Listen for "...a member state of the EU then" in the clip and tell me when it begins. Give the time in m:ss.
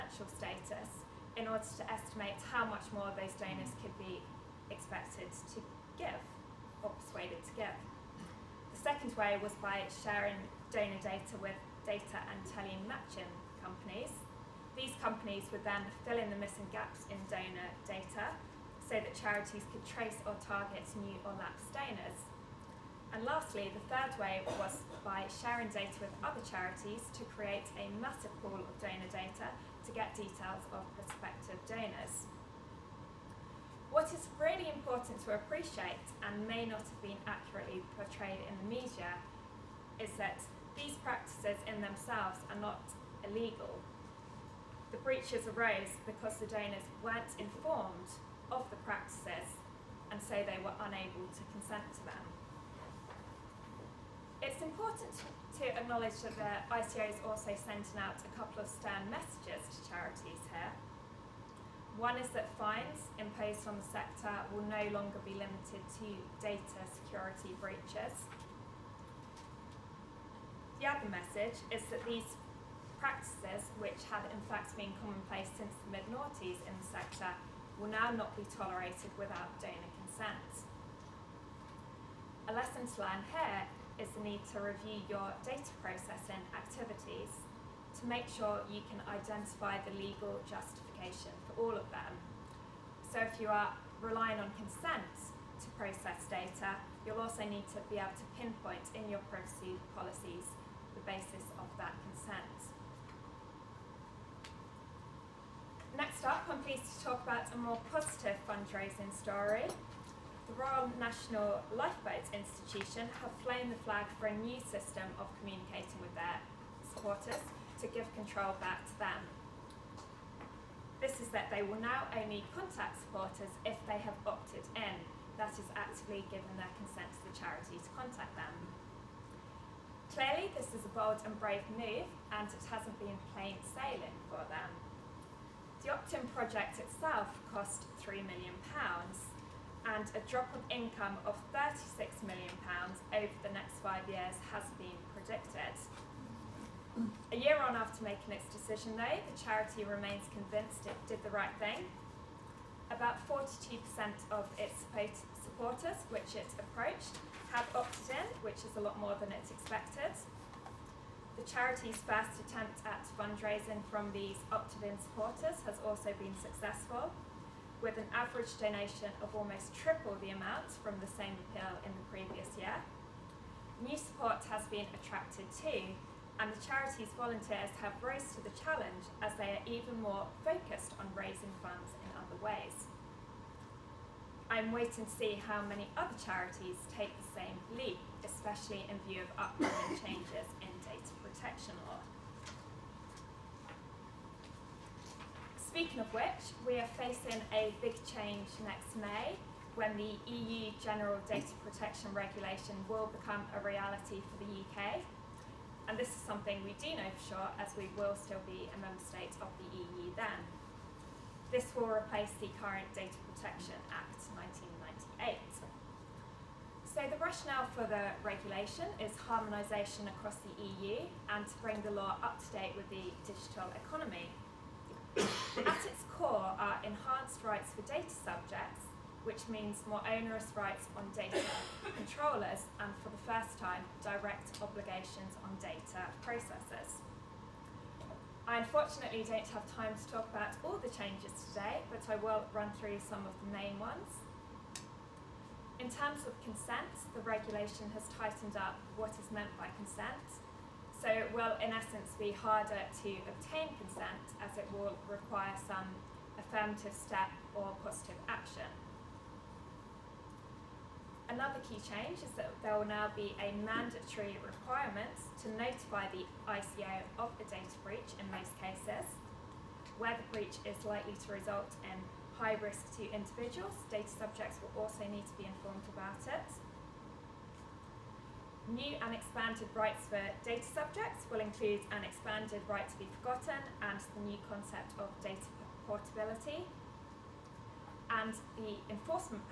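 3:28.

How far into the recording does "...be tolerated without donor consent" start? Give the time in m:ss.
1:18.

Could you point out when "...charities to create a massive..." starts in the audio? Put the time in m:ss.
0:26.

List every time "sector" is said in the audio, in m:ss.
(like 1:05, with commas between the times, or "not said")
1:03, 1:16.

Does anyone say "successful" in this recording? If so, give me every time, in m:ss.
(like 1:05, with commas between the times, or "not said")
2:46.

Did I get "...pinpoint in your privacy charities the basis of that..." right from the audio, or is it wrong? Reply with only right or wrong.
wrong.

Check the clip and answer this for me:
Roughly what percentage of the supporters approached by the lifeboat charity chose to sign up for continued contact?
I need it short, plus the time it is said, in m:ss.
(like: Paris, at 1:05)
42%, at 2:33.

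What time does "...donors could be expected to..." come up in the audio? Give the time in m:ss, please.
0:03.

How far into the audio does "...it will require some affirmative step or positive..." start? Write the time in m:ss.
4:14.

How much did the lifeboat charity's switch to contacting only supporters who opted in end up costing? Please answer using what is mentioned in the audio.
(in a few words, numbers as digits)
£3 million.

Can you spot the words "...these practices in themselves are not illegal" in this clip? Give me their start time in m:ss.
0:40.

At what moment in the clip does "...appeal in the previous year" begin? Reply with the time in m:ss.
2:51.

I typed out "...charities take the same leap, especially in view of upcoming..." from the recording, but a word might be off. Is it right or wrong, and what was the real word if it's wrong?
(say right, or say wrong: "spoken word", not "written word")
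right.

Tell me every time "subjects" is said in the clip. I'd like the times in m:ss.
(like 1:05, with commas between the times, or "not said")
3:48, 4:34, 4:40.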